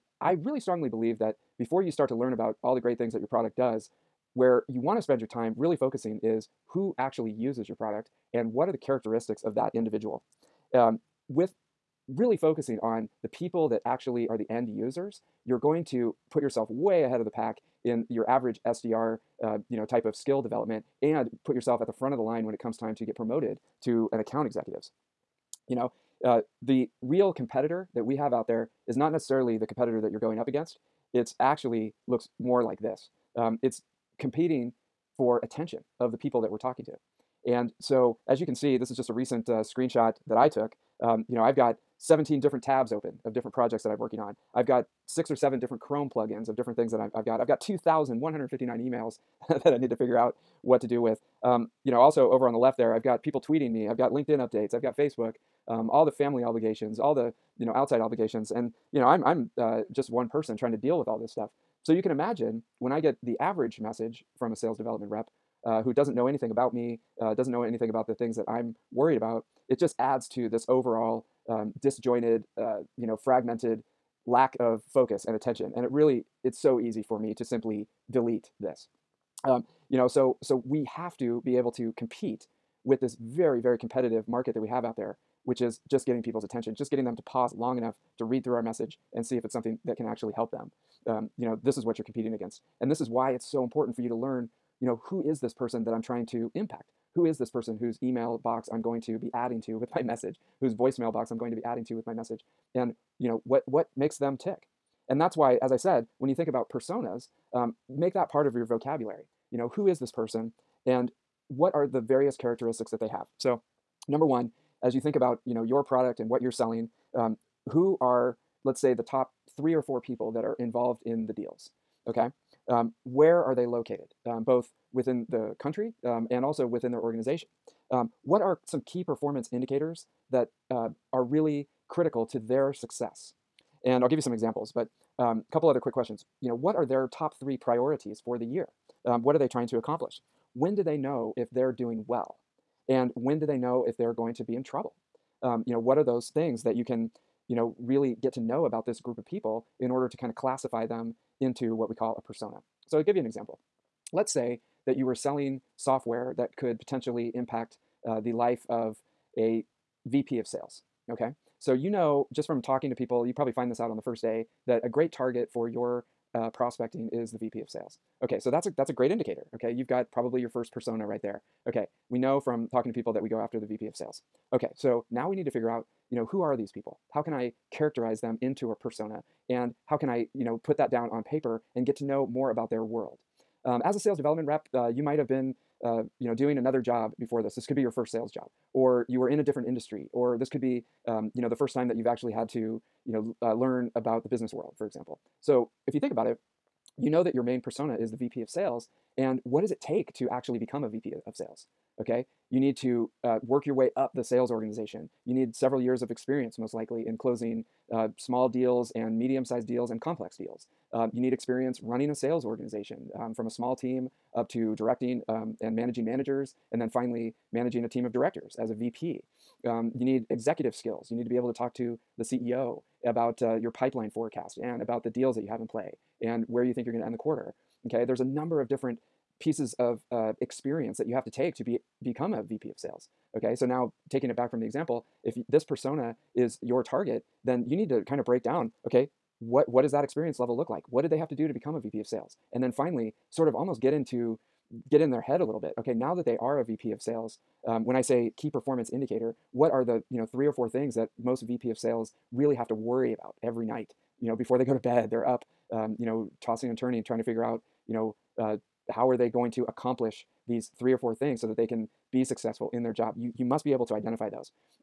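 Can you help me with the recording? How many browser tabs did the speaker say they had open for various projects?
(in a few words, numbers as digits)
17.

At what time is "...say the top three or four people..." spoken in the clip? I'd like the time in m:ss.
1:58.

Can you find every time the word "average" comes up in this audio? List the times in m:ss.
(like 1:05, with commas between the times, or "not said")
0:18, 1:03.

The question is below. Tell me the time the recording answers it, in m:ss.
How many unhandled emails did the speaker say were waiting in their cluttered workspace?
0:47.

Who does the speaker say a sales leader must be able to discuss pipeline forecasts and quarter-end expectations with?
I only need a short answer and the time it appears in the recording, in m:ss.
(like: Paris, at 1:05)
CEO, at 3:42.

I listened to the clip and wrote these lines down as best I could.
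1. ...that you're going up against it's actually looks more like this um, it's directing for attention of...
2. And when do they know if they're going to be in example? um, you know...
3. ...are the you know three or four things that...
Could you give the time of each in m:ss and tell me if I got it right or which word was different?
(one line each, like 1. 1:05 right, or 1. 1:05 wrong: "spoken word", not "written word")
1. 0:29 wrong: "competing", not "directing"
2. 2:22 wrong: "trouble", not "example"
3. 4:09 right.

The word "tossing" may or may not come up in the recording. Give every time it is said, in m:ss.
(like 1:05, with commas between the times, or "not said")
4:16.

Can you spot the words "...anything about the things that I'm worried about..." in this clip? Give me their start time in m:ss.
1:07.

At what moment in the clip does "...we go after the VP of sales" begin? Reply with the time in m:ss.
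2:53.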